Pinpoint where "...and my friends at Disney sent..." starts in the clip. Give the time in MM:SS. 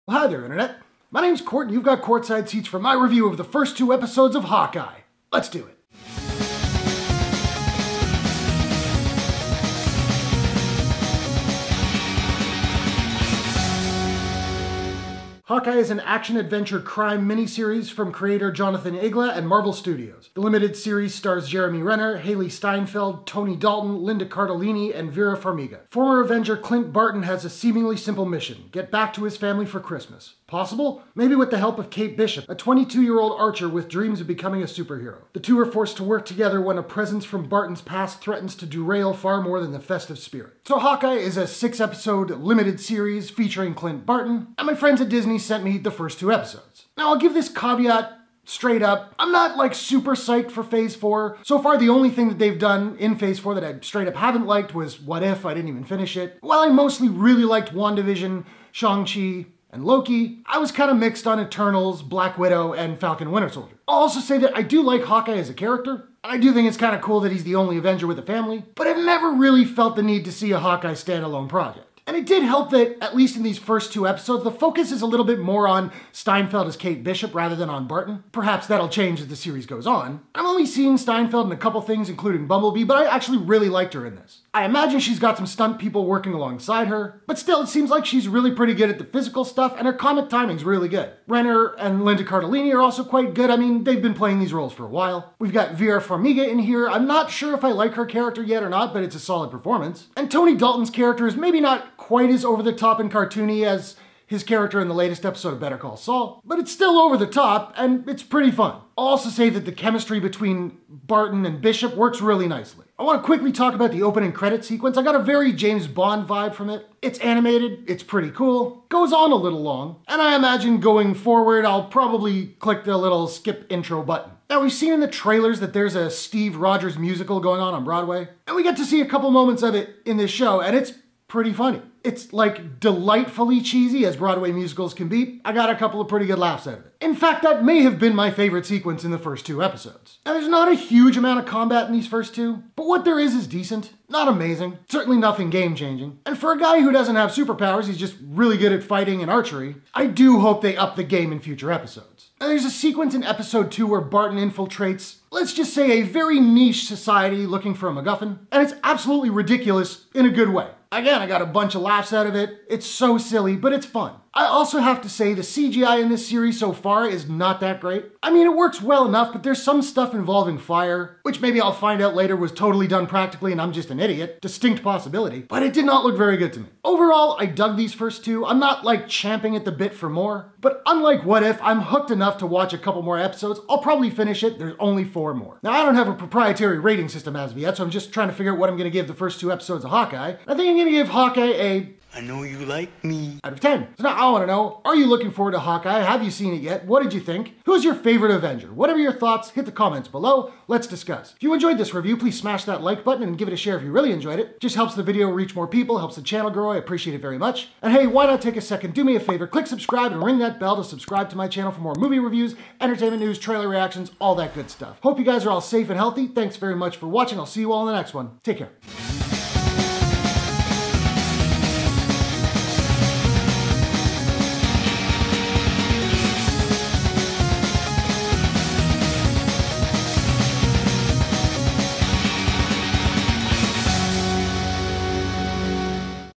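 00:44.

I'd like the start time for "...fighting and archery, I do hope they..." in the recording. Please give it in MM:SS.
02:28.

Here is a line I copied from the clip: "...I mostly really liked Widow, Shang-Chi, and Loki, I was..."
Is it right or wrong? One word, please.
wrong.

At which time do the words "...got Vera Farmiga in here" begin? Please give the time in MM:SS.
01:35.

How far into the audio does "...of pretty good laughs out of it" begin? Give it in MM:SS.
02:16.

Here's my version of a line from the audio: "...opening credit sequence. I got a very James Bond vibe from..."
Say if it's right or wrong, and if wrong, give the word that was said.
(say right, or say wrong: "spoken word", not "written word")
right.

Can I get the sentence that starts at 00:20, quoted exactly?
The limited series stars Jeremy Renner, Hailee Steinfeld, Tony Dalton, Linda Cardellini, and Vera Farmiga.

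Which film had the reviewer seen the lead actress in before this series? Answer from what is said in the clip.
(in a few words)
Bumblebee.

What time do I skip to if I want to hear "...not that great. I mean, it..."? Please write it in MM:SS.
02:47.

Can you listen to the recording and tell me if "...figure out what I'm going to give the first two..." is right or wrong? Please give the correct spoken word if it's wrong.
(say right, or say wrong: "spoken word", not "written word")
right.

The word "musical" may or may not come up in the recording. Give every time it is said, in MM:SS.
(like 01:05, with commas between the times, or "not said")
02:06, 02:14.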